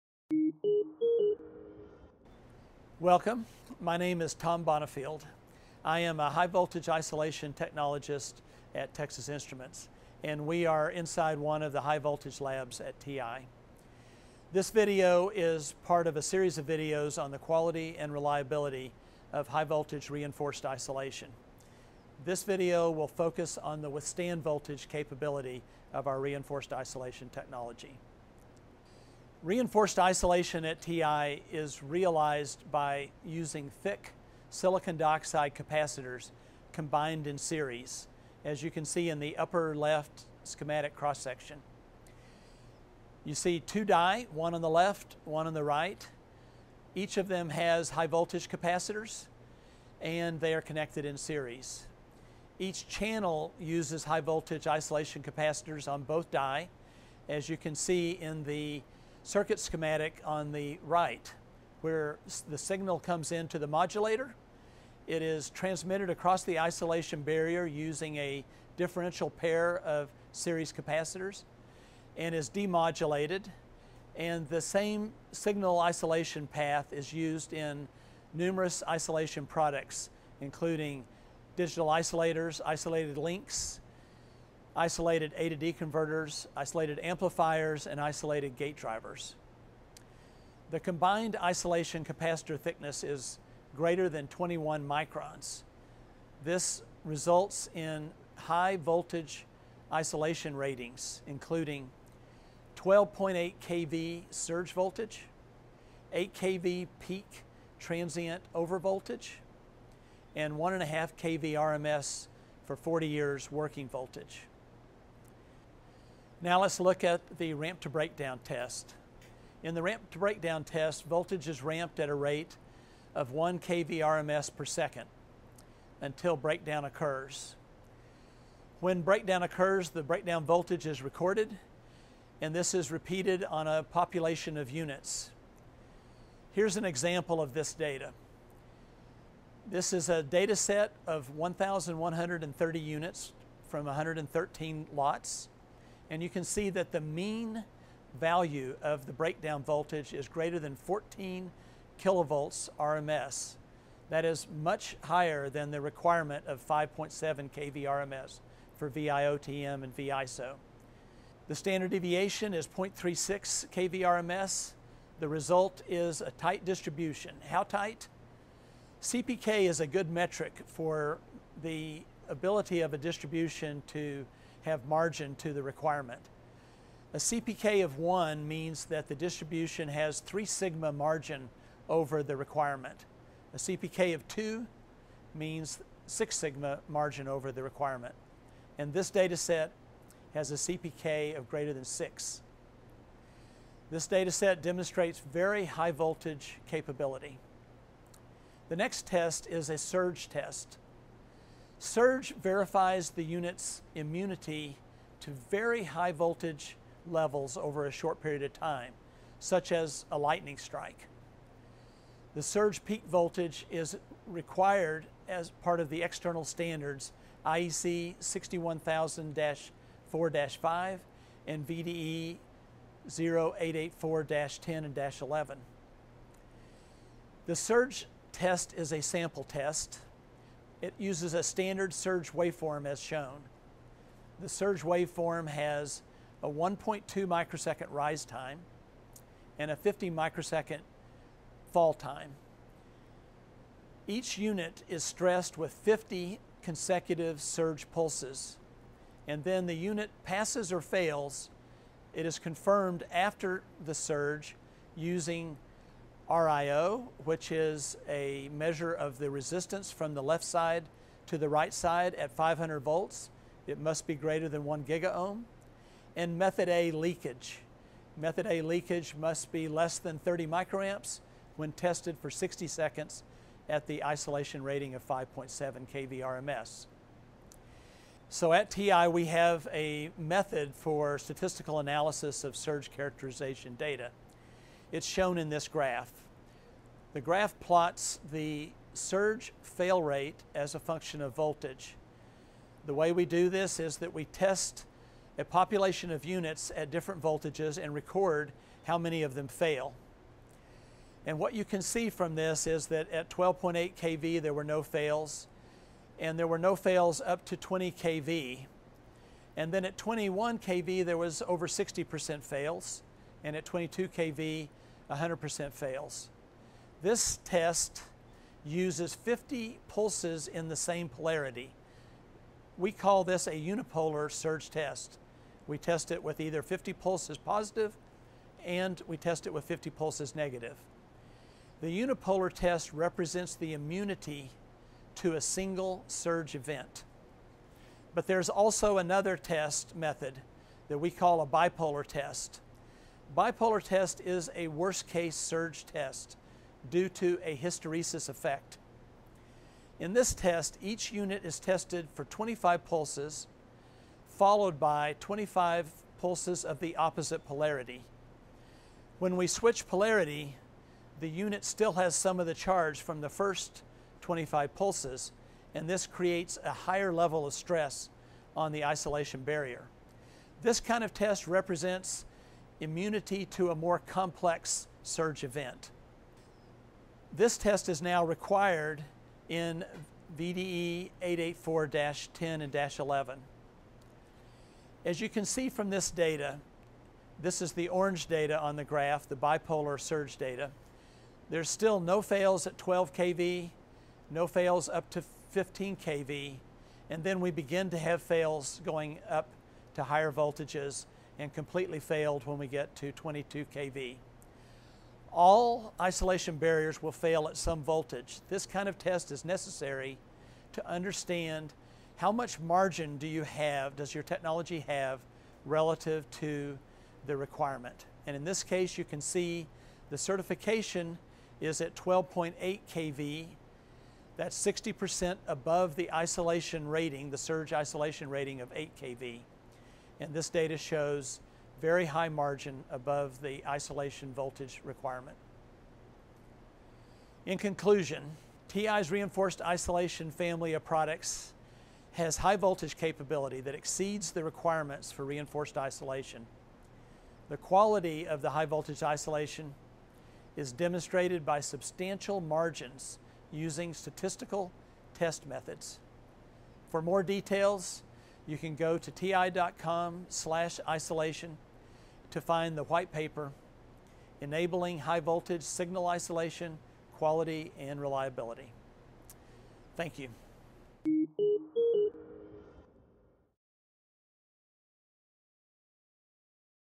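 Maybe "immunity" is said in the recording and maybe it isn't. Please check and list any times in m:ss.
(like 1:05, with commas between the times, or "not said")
3:23, 5:33, 6:12.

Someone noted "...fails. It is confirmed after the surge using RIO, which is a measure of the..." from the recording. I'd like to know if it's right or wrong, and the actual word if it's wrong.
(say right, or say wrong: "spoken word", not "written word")
right.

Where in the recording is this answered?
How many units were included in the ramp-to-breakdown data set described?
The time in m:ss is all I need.
2:21.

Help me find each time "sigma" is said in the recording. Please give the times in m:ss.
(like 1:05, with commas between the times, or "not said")
3:00, 3:06.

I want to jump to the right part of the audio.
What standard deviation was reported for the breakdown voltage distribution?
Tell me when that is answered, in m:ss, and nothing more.
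2:42.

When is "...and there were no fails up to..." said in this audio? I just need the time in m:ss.
5:06.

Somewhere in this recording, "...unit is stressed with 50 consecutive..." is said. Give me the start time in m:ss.
4:04.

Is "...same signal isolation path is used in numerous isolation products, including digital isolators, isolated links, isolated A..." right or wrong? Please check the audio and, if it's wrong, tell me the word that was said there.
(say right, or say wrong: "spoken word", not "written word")
right.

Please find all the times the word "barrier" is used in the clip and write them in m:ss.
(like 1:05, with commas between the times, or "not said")
1:07, 6:09, 6:46.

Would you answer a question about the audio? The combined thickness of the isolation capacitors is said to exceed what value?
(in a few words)
21 microns.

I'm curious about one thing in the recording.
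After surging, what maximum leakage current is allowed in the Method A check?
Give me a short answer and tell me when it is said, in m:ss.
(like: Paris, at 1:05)
30 microamps, at 4:30.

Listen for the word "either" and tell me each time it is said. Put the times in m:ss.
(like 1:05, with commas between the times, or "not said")
5:26.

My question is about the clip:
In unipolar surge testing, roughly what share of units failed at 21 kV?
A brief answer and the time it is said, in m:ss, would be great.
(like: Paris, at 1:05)
over 60%, at 5:11.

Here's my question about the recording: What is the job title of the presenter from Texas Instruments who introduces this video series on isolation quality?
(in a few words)
high voltage isolation technologist.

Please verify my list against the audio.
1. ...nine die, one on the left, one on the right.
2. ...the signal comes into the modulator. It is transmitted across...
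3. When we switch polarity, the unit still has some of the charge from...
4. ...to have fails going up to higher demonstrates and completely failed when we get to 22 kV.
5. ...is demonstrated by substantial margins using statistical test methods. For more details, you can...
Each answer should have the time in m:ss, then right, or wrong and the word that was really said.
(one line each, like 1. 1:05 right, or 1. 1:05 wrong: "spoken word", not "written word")
1. 0:43 wrong: "two", not "nine"
2. 1:02 right
3. 5:59 right
4. 6:37 wrong: "voltages", not "demonstrates"
5. 7:30 right.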